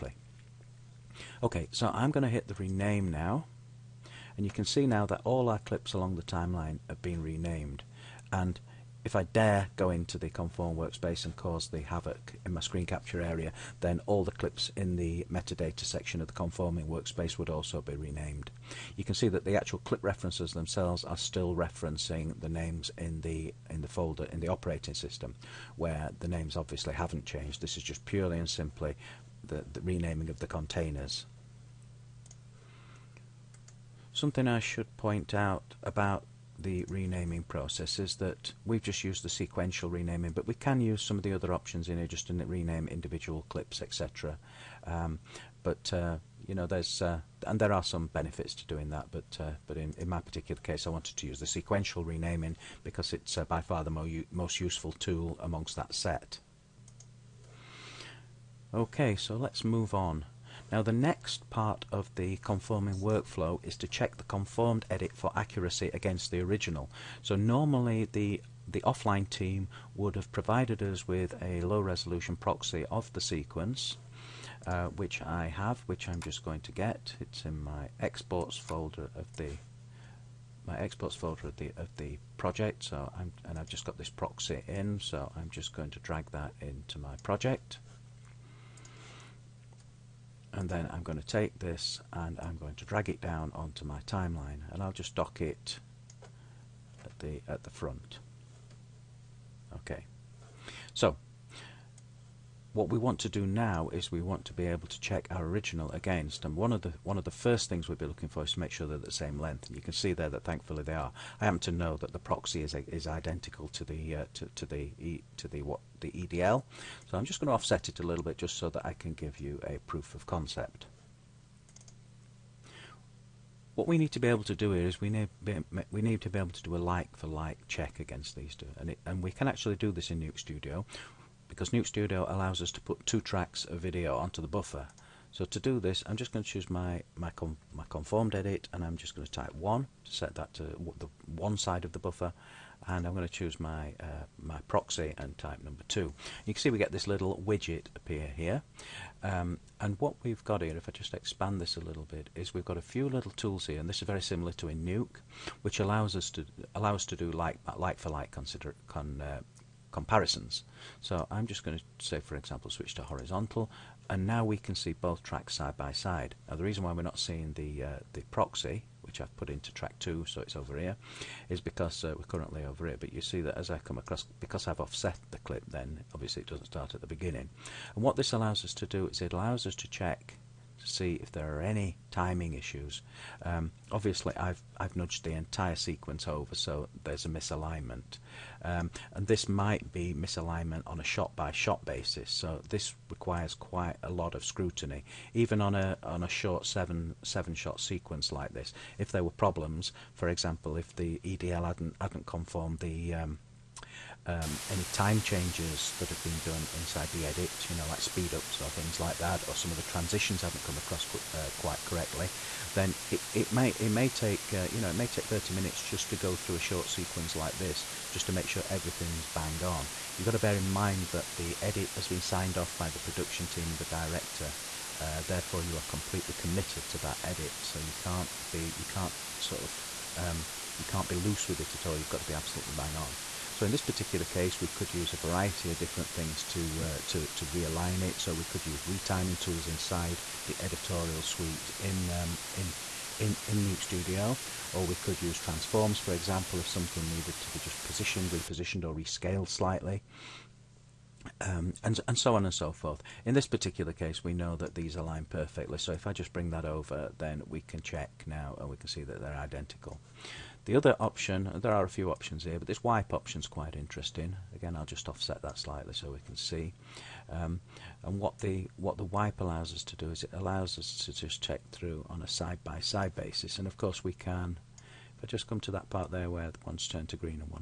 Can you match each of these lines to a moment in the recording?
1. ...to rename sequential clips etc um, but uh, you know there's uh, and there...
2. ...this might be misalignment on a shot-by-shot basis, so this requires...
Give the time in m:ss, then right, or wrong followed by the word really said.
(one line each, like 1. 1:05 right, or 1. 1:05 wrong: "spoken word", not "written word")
1. 0:42 wrong: "individual", not "sequential"
2. 3:09 right.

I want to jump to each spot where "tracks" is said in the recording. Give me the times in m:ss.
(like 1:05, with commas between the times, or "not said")
2:13, 2:45, 2:49.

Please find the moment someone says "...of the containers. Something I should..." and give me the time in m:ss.
0:30.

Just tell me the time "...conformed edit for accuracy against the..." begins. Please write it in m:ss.
1:04.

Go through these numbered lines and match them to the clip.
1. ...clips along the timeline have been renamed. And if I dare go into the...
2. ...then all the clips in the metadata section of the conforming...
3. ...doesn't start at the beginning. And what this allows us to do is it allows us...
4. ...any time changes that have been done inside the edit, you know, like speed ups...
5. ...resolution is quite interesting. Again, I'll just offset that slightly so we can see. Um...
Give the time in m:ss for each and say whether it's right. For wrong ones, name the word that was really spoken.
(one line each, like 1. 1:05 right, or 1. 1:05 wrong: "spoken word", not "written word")
1. 0:05 right
2. 0:13 right
3. 2:56 right
4. 3:24 right
5. 4:23 wrong: "option", not "resolution".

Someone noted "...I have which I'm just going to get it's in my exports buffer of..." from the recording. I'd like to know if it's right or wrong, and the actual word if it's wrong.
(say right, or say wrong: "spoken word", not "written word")
wrong: "folder", not "buffer".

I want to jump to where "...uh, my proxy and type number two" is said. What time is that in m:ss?
2:24.